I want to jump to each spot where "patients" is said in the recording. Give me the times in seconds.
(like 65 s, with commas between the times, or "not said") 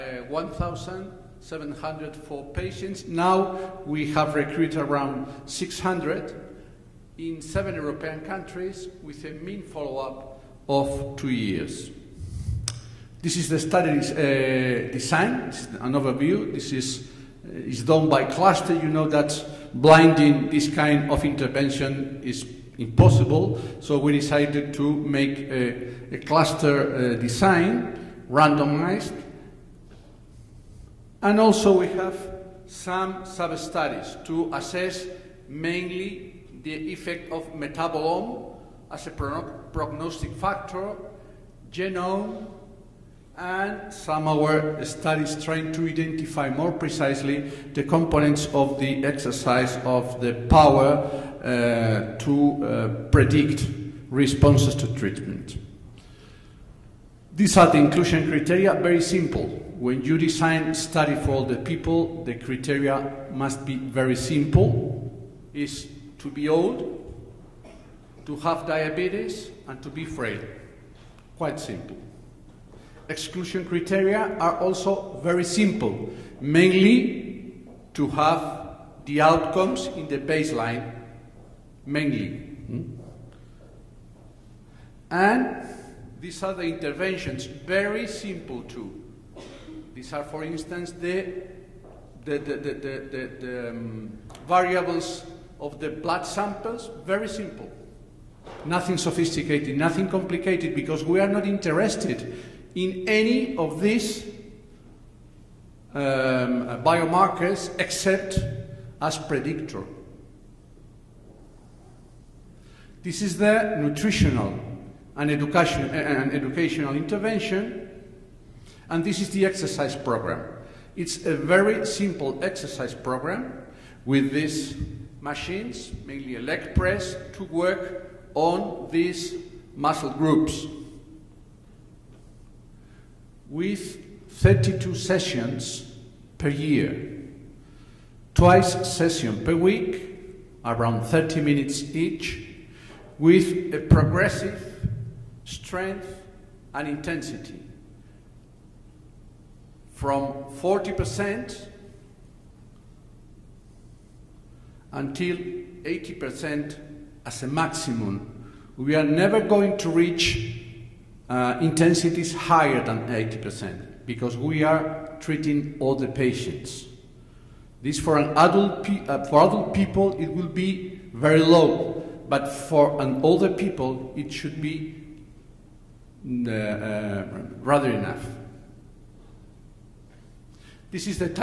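2 s, 166 s.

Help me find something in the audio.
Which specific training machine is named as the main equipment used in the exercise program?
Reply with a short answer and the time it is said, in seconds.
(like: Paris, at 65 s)
Leg press, at 126 s.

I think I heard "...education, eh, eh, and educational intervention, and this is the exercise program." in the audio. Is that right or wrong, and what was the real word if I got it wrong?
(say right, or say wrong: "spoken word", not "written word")
right.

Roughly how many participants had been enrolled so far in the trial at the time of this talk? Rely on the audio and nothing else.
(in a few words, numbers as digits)
600.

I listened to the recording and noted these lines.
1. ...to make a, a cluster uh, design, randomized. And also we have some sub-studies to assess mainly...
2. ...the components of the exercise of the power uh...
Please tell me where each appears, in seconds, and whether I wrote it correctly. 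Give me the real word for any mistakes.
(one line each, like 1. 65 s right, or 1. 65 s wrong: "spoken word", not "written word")
1. 24 s right
2. 47 s right.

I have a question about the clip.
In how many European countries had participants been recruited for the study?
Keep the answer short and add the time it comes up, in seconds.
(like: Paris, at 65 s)
7, at 7 s.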